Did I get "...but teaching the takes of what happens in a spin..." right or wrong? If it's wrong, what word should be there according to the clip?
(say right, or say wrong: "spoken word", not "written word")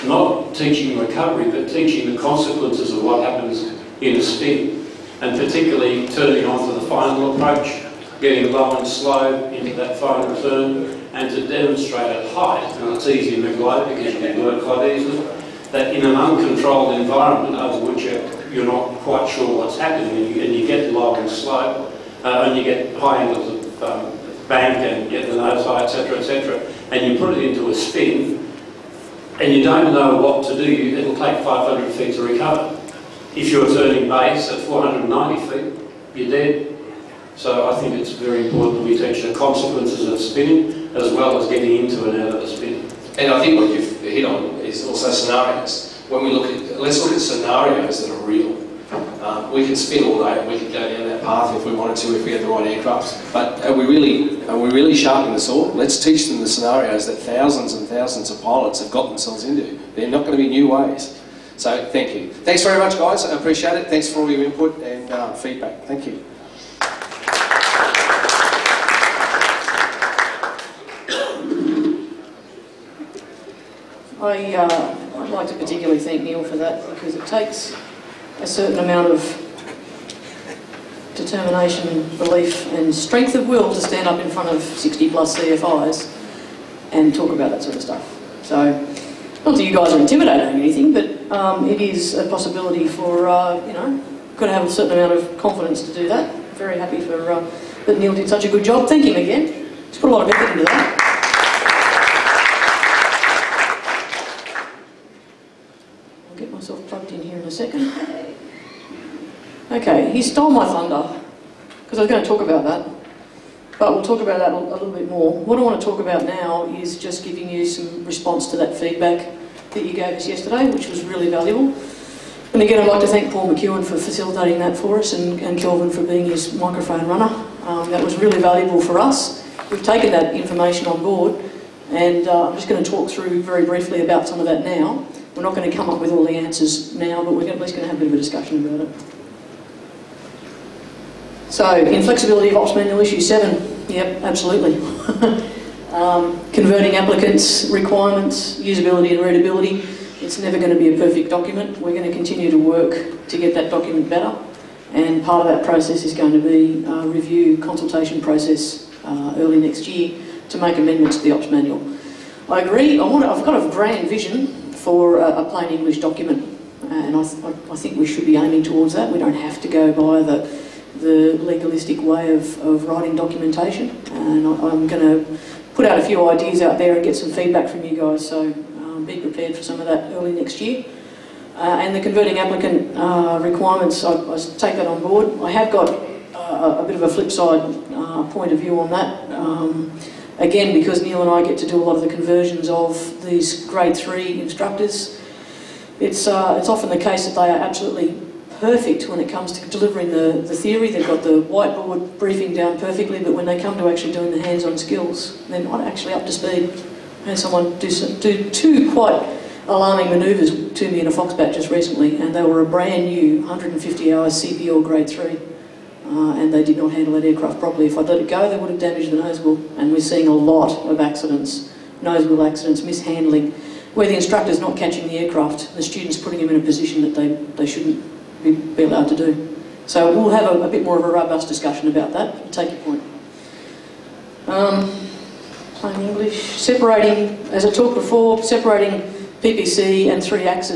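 wrong: "consequences", not "takes".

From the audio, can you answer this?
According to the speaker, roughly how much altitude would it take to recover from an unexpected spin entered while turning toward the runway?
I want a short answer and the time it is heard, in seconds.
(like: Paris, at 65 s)
500 feet, at 31 s.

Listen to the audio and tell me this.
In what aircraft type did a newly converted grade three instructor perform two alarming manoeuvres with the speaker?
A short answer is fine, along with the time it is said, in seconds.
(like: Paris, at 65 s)
Foxbat, at 211 s.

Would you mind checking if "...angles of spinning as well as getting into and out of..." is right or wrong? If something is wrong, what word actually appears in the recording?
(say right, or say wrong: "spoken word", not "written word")
wrong: "consequences", not "angles".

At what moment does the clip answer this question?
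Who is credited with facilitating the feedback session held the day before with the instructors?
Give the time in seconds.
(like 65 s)
123 s.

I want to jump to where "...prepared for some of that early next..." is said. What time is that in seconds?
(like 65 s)
179 s.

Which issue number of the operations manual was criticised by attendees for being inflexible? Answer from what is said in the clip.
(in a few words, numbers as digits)
7.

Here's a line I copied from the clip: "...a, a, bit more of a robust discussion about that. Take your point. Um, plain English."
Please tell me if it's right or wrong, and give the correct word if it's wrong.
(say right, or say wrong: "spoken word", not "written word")
right.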